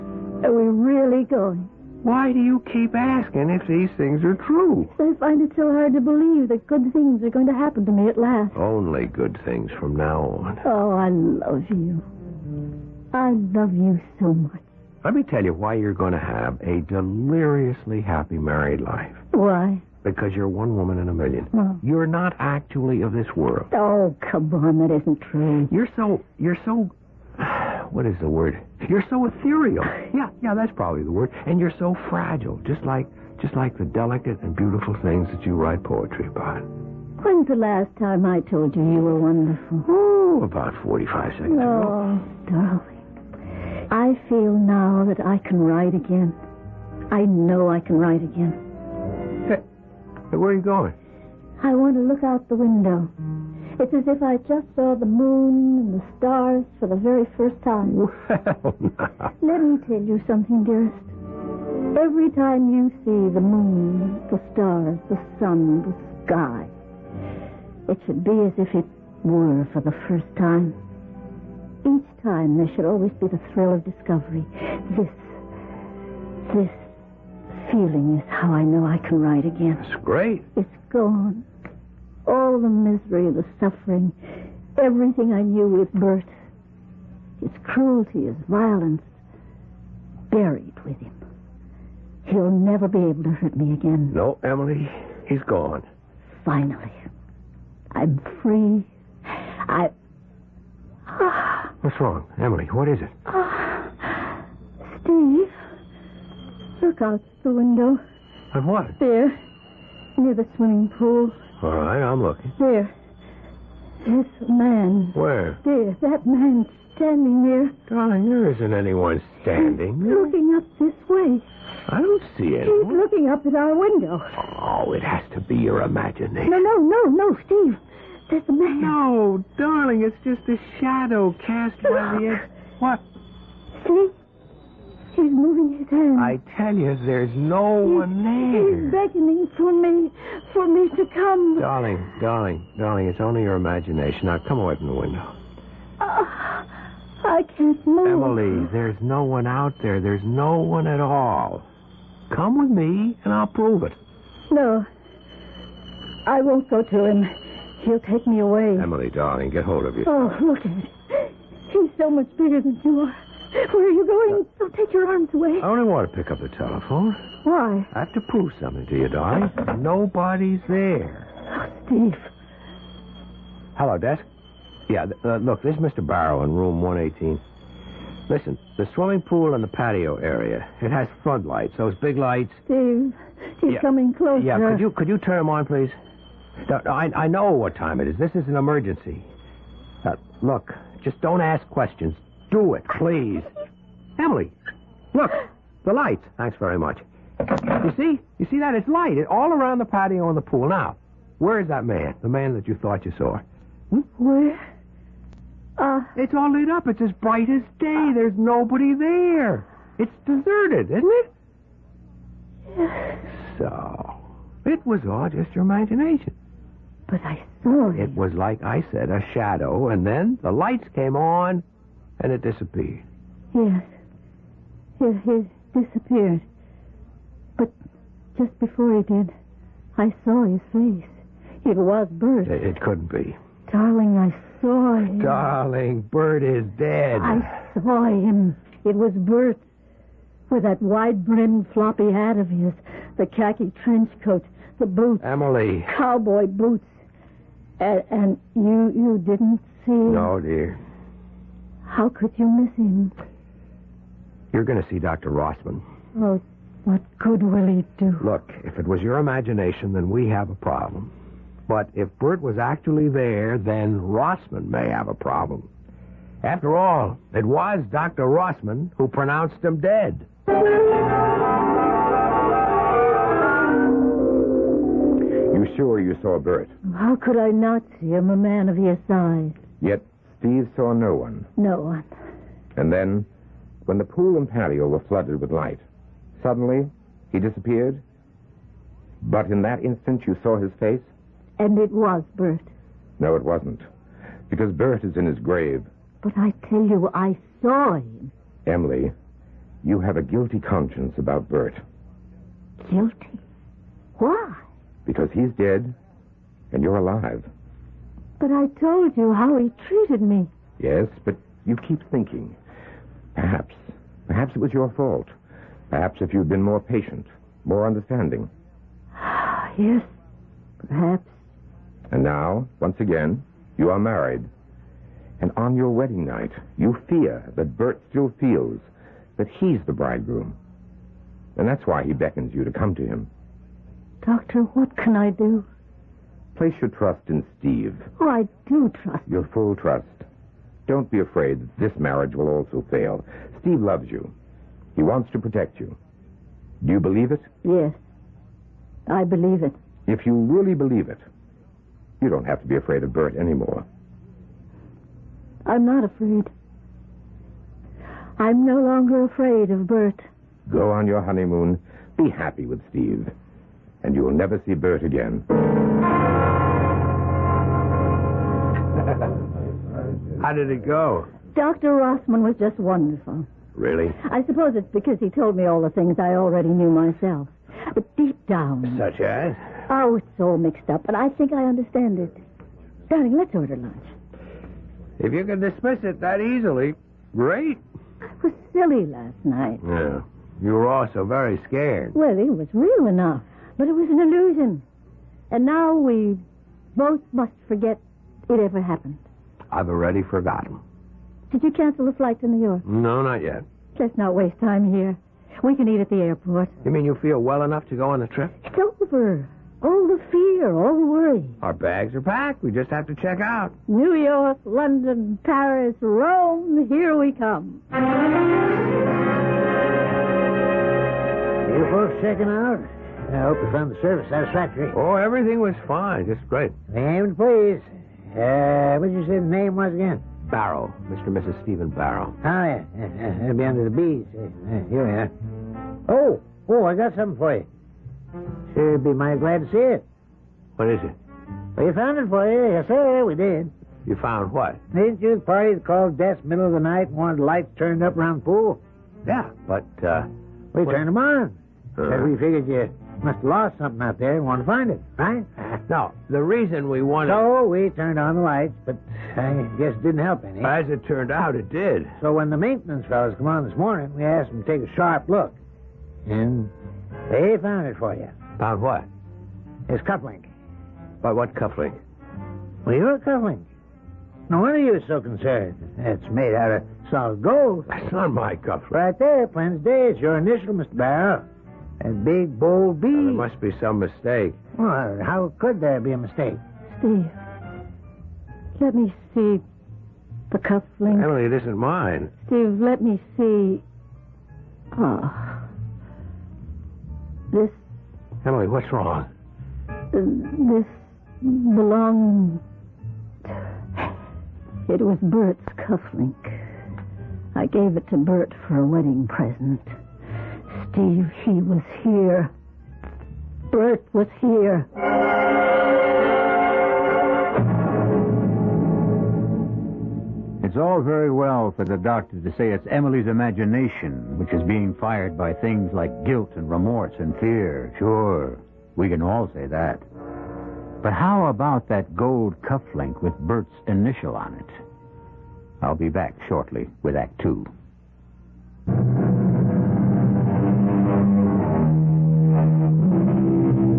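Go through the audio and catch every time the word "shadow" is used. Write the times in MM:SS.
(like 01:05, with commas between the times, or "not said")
02:10, 03:39.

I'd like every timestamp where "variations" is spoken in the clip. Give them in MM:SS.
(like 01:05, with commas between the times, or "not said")
not said.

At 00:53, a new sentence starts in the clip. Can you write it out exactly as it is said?
It's as if I just saw the moon and the stars for the very first time.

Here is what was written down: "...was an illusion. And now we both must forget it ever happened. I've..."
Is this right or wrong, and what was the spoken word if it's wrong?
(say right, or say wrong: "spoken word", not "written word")
right.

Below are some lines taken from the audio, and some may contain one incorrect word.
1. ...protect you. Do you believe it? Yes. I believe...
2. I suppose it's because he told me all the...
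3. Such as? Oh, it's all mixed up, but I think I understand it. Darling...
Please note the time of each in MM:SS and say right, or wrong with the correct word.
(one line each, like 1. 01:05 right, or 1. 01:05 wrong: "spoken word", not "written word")
1. 05:45 right
2. 06:14 right
3. 06:18 right.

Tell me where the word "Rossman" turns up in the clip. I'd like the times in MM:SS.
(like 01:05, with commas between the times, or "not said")
04:15, 04:23, 04:28, 06:11.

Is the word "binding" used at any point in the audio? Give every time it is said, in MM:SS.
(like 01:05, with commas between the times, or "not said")
not said.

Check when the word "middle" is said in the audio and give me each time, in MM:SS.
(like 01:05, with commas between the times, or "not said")
07:26.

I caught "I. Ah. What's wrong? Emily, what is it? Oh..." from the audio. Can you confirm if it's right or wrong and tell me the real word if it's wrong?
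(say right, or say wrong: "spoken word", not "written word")
right.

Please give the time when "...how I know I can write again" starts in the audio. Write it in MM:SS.
01:18.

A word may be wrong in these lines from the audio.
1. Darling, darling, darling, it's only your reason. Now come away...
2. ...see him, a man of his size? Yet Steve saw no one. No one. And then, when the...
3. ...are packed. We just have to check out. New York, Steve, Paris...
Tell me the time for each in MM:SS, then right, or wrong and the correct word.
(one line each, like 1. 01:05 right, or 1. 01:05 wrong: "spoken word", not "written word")
1. 02:21 wrong: "imagination", not "reason"
2. 04:37 right
3. 06:52 wrong: "London", not "Steve".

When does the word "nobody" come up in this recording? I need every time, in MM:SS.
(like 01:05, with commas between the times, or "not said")
02:49, 03:28.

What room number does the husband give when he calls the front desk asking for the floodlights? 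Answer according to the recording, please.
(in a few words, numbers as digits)
118.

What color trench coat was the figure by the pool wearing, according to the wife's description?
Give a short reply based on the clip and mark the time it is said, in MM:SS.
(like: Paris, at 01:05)
khaki, at 04:03.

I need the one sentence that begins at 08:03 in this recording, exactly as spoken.
Now, there must be some mistake.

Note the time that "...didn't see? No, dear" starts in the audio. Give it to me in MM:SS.
04:09.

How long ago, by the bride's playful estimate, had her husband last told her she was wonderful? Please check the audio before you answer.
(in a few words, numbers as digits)
45 seconds.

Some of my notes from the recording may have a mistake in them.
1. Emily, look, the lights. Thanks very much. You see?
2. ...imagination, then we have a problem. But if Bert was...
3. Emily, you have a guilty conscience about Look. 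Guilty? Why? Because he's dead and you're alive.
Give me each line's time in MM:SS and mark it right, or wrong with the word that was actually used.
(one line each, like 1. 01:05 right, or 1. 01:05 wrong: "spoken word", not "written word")
1. 03:14 right
2. 04:19 right
3. 04:58 wrong: "Bert", not "Look".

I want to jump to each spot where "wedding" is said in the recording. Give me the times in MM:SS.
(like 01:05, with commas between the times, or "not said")
05:25, 08:28.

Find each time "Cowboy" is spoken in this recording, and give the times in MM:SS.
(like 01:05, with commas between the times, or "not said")
04:05.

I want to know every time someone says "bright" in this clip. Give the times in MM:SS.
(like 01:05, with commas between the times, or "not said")
03:27.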